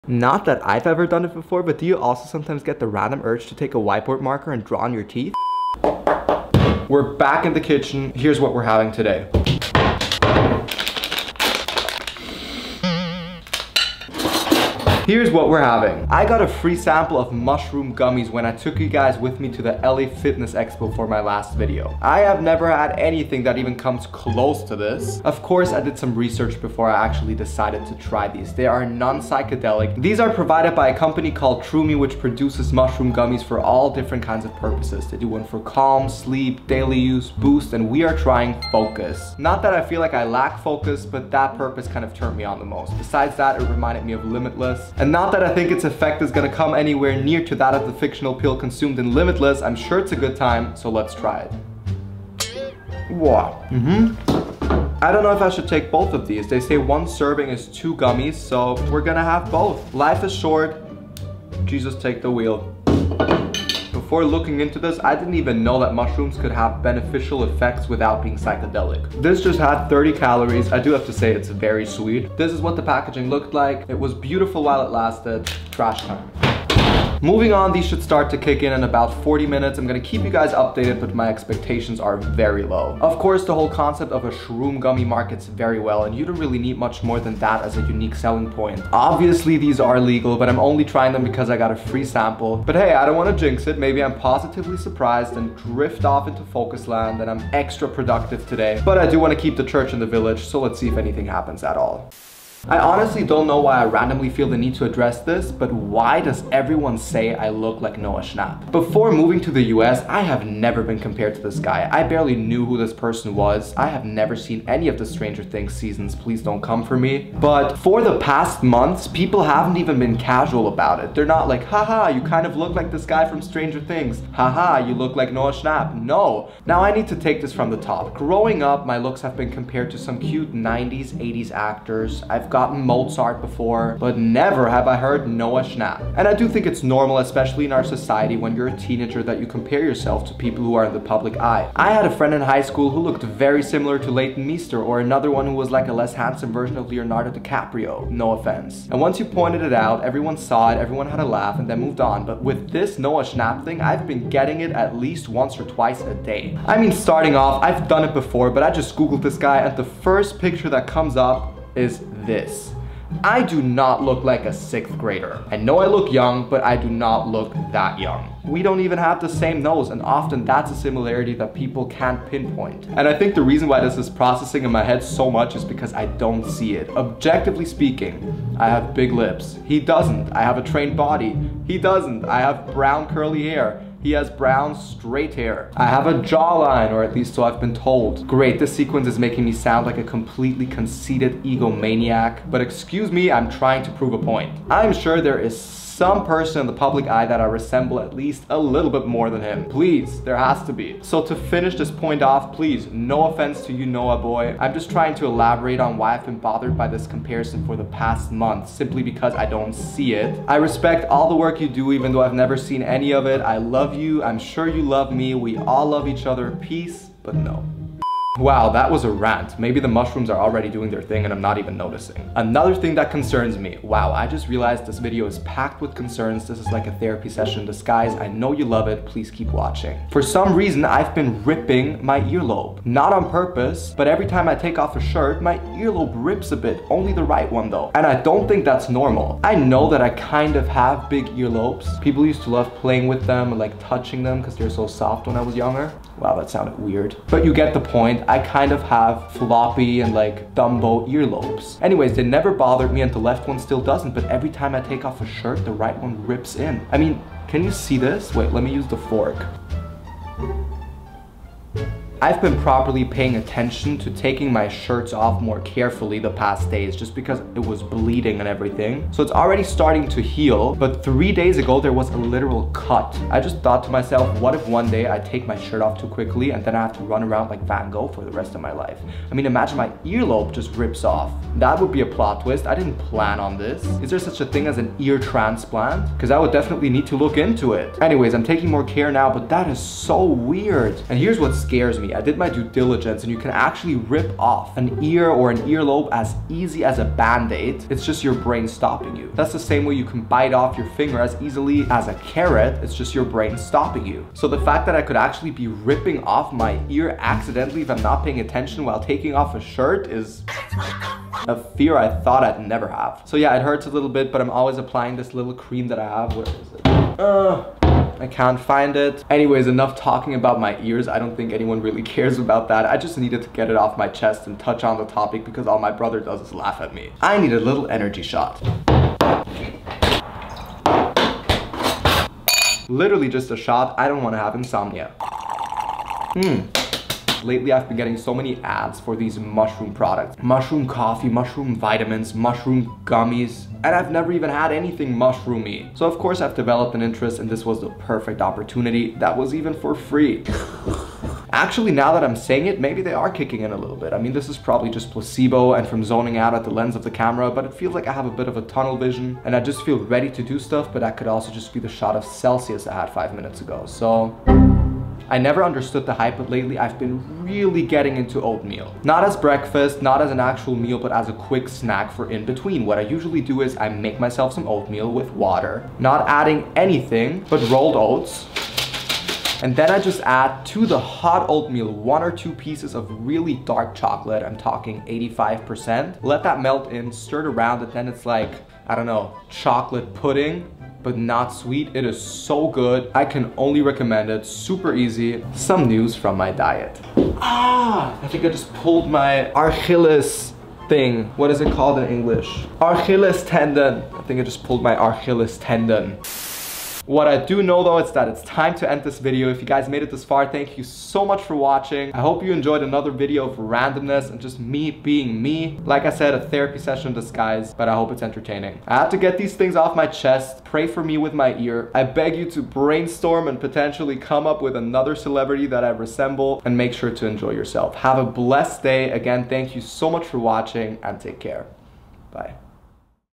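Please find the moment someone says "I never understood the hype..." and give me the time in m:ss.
6:05.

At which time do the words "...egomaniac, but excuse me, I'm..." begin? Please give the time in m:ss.
3:11.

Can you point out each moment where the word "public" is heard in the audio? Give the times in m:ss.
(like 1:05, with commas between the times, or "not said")
2:20, 3:16.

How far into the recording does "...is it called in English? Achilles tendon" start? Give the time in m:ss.
6:41.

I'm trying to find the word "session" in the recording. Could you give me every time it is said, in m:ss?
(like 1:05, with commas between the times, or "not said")
3:47, 6:56.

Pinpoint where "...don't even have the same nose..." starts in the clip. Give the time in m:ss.
2:48.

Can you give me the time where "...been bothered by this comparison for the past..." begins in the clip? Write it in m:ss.
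3:26.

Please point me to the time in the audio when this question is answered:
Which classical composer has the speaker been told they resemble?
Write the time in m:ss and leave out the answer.
2:12.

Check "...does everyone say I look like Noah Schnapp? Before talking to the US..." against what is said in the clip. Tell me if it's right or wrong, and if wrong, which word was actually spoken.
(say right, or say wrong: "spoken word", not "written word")
wrong: "moving", not "talking".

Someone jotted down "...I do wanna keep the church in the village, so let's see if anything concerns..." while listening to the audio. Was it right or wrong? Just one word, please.
wrong.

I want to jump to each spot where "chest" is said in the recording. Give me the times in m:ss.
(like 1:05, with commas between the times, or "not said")
5:24, 7:00.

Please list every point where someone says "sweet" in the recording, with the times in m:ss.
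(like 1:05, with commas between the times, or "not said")
1:11, 6:31.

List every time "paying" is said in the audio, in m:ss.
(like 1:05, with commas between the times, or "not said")
4:23, 5:08.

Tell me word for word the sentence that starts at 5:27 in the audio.
I need a little energy shot.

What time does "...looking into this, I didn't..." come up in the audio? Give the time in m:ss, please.
1:04.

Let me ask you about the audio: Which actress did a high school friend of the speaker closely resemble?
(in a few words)
Leighton Meester.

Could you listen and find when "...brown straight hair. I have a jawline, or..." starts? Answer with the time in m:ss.
3:04.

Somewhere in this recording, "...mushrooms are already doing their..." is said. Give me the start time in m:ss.
3:39.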